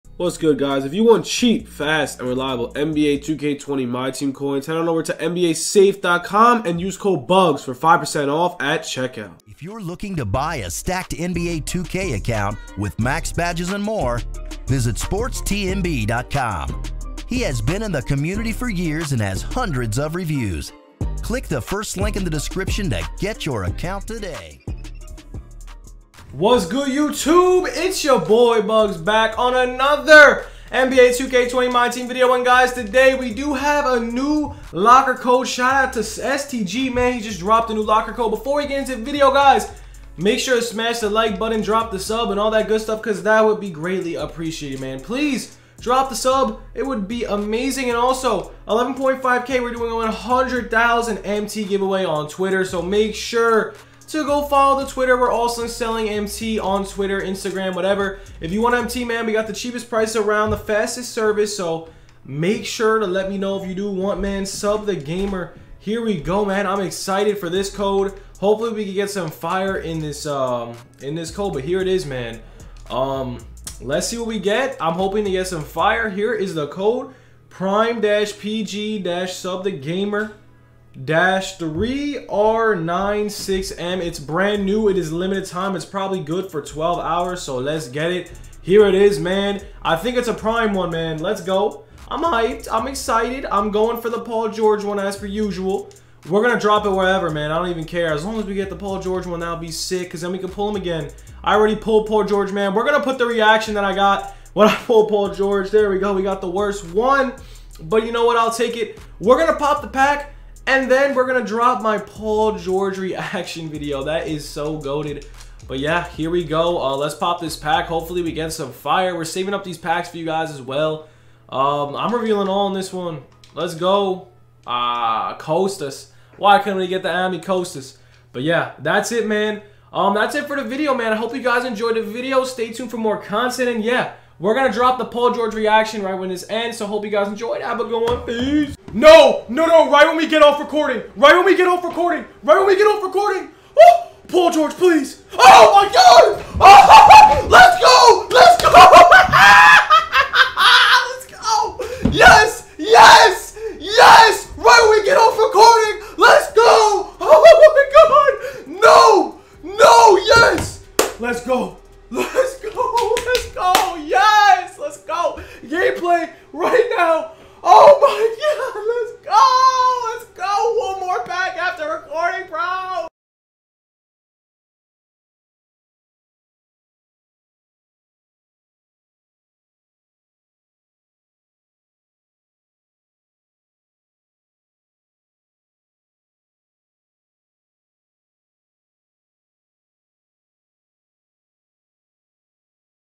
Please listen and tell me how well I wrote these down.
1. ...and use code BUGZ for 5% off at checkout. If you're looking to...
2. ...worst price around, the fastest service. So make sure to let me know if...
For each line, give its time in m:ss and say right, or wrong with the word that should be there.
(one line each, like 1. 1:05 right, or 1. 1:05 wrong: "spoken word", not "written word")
1. 0:06 right
2. 0:59 wrong: "cheapest", not "worst".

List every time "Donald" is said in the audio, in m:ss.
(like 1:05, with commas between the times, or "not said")
not said.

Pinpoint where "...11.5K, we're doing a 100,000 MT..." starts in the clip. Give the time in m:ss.
0:48.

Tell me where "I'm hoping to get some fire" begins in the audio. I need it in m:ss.
1:14.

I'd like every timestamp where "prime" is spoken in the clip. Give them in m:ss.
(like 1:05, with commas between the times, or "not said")
1:17, 1:30.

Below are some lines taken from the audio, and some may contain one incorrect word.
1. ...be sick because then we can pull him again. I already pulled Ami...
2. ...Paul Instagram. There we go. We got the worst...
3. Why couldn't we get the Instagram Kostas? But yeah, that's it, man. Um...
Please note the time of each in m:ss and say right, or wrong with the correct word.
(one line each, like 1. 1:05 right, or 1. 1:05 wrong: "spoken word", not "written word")
1. 1:39 wrong: "Paul", not "Ami"
2. 1:45 wrong: "George", not "Instagram"
3. 2:06 wrong: "Ami", not "Instagram".